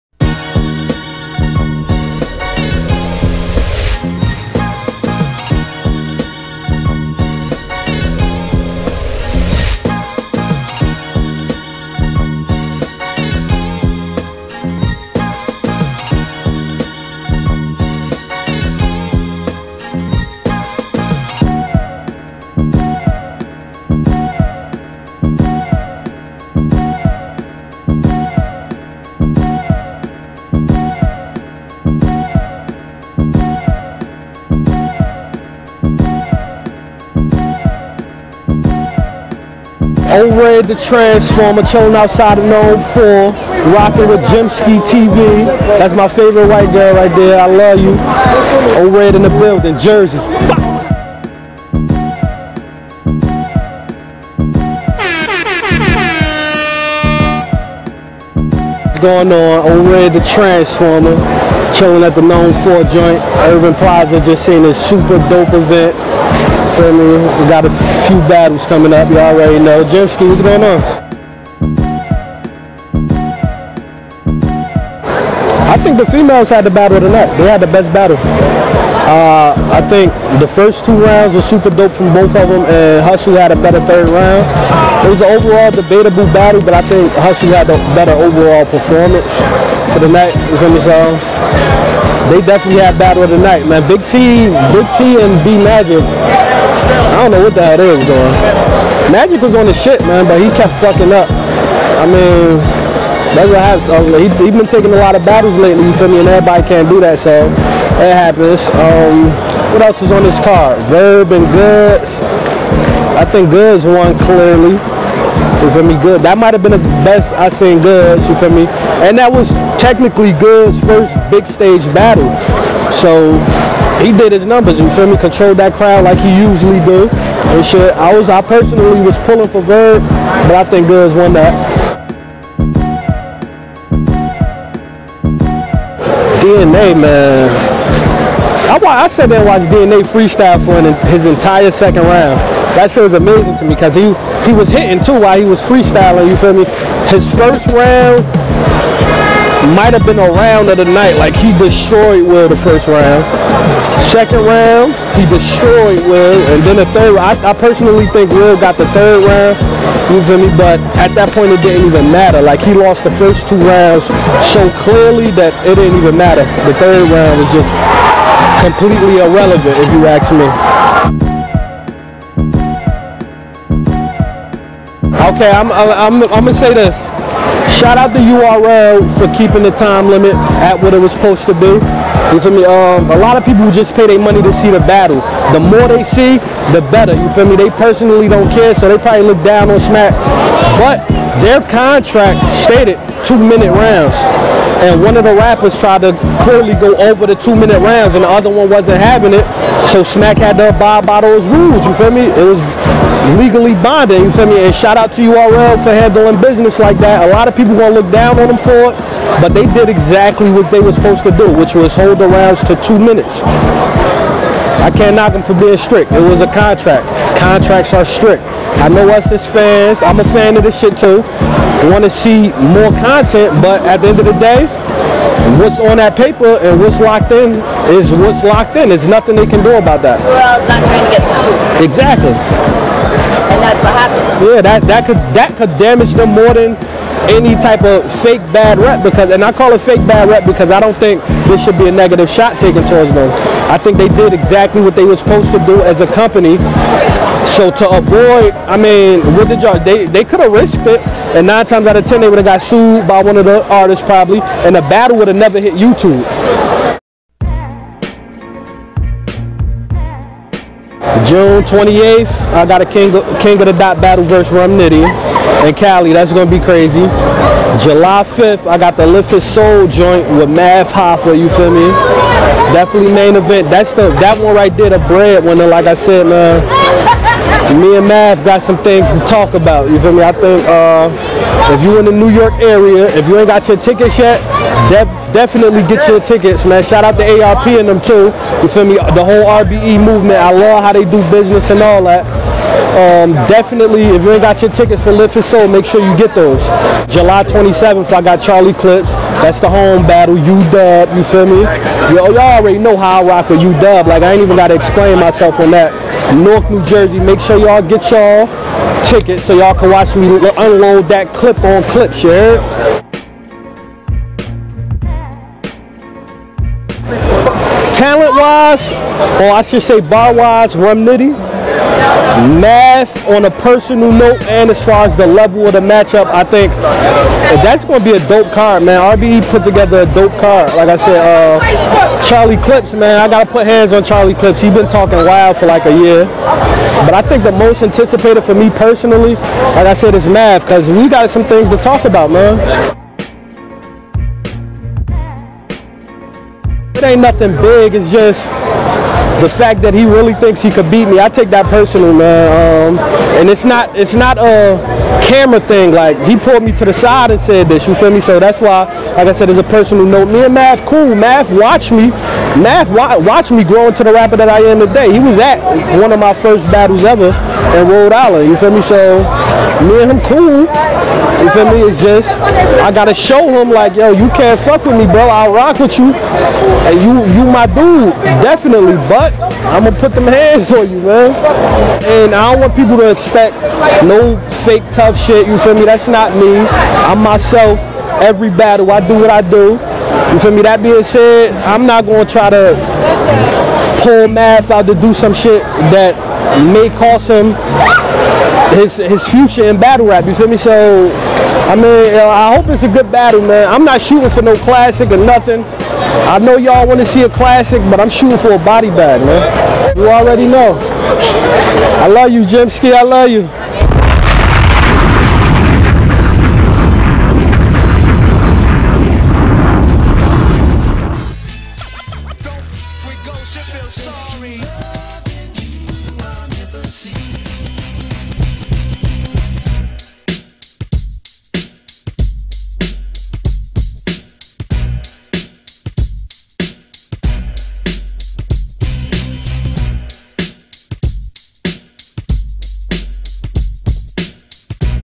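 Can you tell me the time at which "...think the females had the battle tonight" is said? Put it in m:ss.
1:15.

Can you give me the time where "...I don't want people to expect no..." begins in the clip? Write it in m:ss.
6:22.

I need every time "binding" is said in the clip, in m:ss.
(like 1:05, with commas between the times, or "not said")
3:23.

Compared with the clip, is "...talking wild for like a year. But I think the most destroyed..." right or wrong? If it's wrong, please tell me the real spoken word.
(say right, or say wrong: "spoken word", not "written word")
wrong: "anticipated", not "destroyed".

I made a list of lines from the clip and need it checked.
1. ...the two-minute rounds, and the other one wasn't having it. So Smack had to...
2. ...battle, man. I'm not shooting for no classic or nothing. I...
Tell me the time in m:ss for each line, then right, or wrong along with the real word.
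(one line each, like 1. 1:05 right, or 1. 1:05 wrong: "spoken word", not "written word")
1. 3:17 right
2. 6:43 right.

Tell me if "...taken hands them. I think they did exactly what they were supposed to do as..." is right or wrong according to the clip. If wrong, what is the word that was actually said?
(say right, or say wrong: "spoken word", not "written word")
wrong: "towards", not "hands".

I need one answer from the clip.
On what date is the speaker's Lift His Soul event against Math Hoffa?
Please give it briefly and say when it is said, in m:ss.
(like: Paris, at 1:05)
July 5, at 4:27.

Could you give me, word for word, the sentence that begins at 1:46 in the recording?
And everybody can't do that, so it happens.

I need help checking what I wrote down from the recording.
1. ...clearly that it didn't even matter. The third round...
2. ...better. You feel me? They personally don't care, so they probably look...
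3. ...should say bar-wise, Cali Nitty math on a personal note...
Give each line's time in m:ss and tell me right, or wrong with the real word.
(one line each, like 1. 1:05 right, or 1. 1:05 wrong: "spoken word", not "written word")
1. 2:44 right
2. 3:06 right
3. 5:19 wrong: "Rum", not "Cali".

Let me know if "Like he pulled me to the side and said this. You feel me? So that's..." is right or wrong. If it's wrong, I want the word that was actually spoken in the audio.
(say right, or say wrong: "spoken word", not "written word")
right.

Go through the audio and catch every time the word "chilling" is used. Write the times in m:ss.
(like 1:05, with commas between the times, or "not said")
0:41, 1:01.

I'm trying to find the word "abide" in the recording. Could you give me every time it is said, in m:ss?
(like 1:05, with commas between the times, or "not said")
3:20.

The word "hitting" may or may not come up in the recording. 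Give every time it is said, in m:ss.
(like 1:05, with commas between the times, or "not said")
2:24.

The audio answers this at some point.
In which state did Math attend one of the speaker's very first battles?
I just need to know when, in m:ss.
6:07.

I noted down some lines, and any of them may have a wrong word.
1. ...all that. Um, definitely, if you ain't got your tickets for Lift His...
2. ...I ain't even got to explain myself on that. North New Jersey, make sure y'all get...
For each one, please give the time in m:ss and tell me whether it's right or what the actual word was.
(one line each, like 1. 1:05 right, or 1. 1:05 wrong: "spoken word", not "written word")
1. 4:51 right
2. 5:04 right.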